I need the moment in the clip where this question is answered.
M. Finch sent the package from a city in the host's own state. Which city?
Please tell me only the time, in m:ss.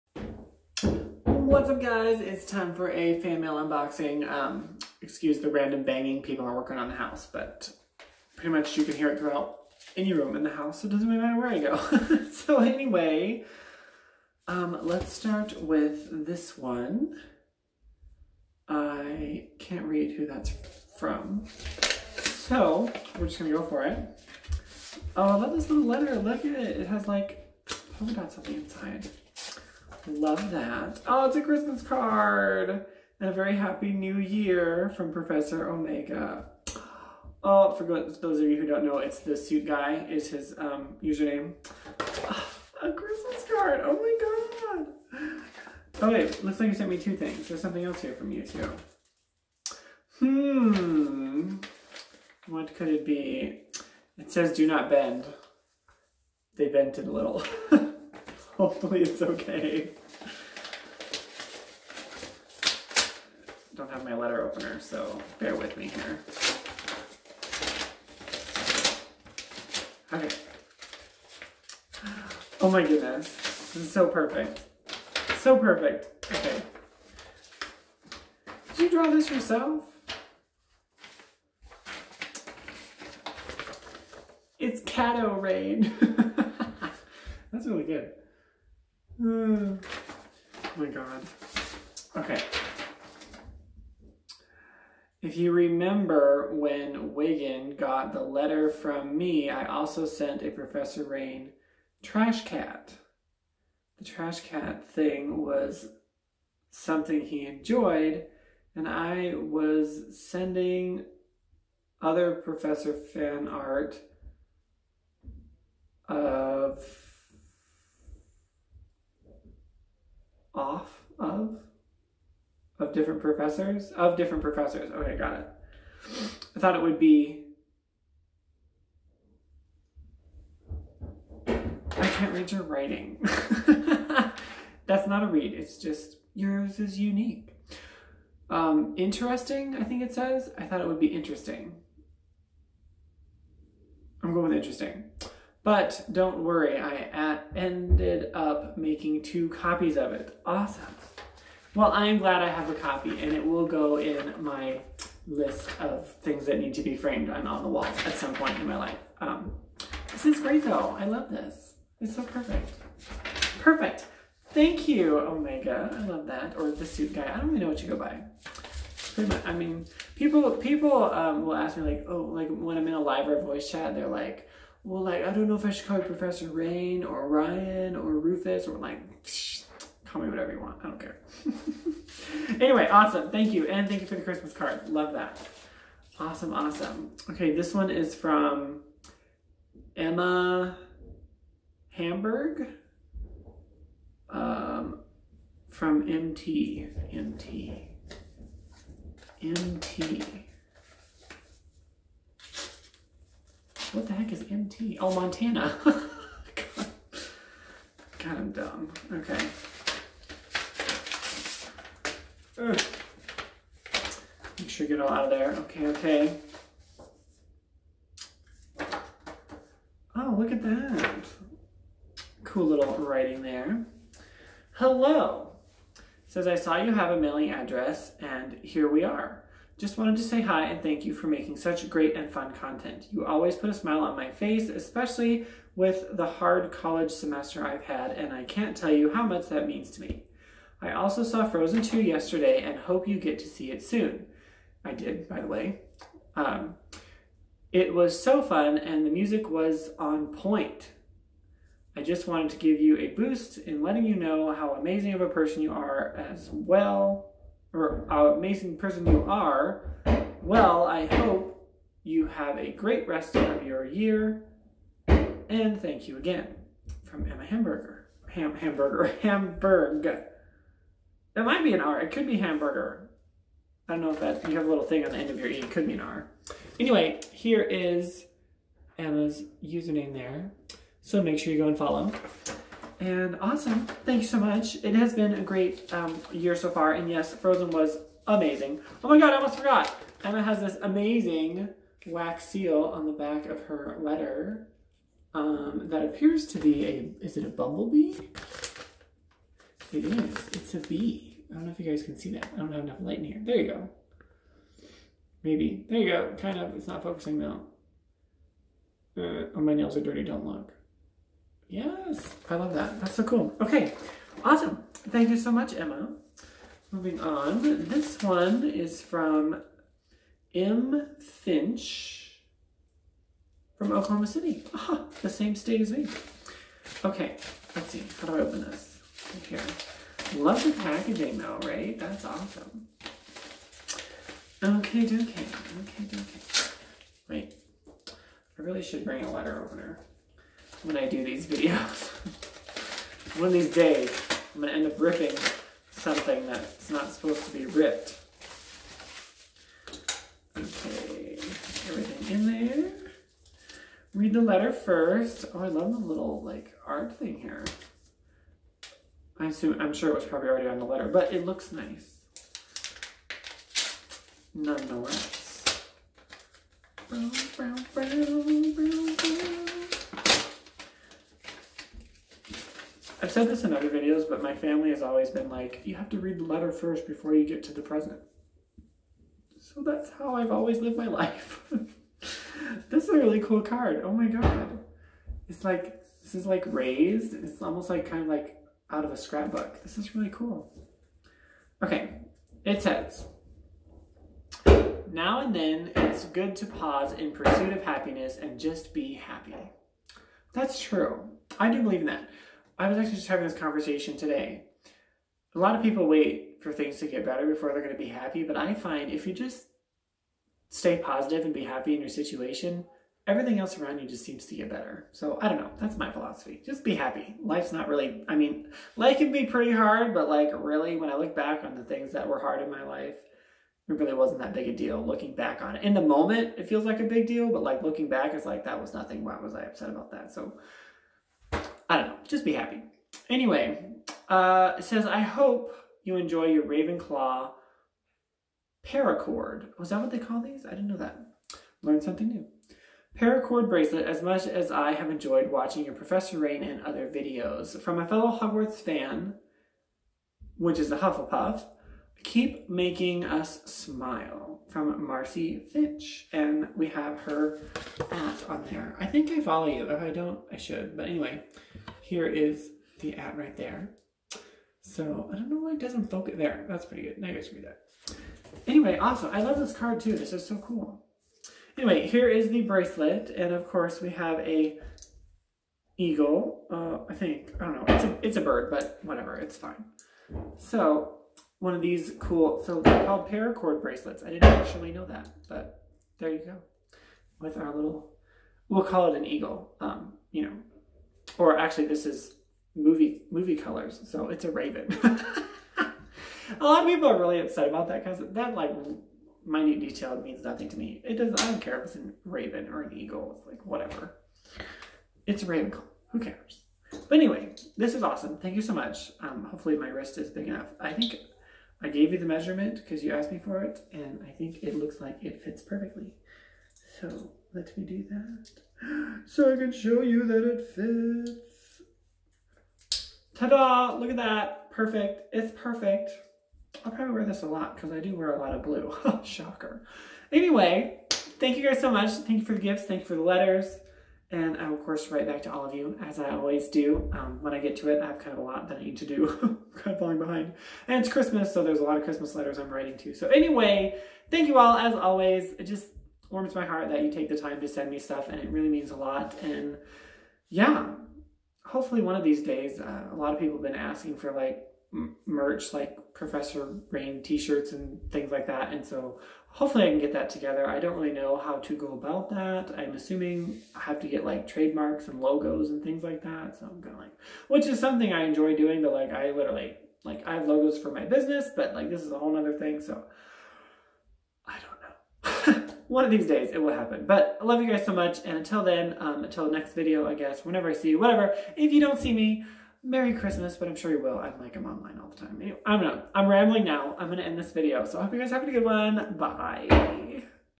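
5:23.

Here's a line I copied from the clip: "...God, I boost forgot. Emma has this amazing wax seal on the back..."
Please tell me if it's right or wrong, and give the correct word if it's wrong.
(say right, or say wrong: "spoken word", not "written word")
wrong: "almost", not "boost".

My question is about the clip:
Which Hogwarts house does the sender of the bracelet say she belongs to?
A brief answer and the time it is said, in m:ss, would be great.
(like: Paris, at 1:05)
Hufflepuff, at 7:30.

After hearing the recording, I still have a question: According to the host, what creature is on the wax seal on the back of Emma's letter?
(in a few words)
A bee.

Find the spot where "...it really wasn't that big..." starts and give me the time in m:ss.
7:03.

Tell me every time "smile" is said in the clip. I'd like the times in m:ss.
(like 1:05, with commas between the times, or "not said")
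3:53, 7:33.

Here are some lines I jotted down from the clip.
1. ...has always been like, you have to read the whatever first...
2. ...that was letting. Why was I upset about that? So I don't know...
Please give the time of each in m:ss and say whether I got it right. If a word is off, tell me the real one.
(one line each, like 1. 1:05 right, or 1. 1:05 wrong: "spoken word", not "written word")
1. 6:14 wrong: "letter", not "whatever"
2. 7:08 wrong: "nothing", not "letting".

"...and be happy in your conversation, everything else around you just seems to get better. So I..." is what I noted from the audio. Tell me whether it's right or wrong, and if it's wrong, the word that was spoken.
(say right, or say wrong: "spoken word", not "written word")
wrong: "situation", not "conversation".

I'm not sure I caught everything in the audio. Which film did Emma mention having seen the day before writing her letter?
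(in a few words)
Frozen 2.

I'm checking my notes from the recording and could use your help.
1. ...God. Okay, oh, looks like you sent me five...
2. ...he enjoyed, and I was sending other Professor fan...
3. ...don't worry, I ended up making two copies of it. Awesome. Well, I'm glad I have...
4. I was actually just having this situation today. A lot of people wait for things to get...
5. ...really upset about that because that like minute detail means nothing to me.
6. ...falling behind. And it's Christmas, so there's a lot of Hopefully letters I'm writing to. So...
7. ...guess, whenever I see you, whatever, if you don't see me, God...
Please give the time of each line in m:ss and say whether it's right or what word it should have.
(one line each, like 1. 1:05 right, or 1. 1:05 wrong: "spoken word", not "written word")
1. 0:45 wrong: "two", not "five"
2. 1:47 right
3. 2:26 right
4. 6:42 wrong: "conversation", not "situation"
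5. 8:17 right
6. 8:59 wrong: "Christmas", not "Hopefully"
7. 9:40 wrong: "Merry", not "God".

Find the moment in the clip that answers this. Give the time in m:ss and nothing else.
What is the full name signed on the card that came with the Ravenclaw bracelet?
7:35.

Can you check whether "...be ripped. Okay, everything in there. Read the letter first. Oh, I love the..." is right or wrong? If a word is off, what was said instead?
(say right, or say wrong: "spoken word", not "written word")
right.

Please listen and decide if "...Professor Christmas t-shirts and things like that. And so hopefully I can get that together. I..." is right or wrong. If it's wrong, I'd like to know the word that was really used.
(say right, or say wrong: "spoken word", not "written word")
wrong: "Rain", not "Christmas".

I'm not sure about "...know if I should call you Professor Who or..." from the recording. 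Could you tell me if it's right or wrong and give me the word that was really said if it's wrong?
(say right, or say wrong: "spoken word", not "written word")
wrong: "Rain", not "Who".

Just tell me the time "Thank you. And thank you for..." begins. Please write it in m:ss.
3:03.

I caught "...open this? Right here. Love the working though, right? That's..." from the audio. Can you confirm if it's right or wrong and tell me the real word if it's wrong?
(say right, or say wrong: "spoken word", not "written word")
wrong: "packaging", not "working".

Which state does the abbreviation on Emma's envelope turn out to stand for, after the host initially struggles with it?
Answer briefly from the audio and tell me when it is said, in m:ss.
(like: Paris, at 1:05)
Montana, at 3:25.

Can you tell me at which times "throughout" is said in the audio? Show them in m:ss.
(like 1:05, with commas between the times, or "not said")
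0:09.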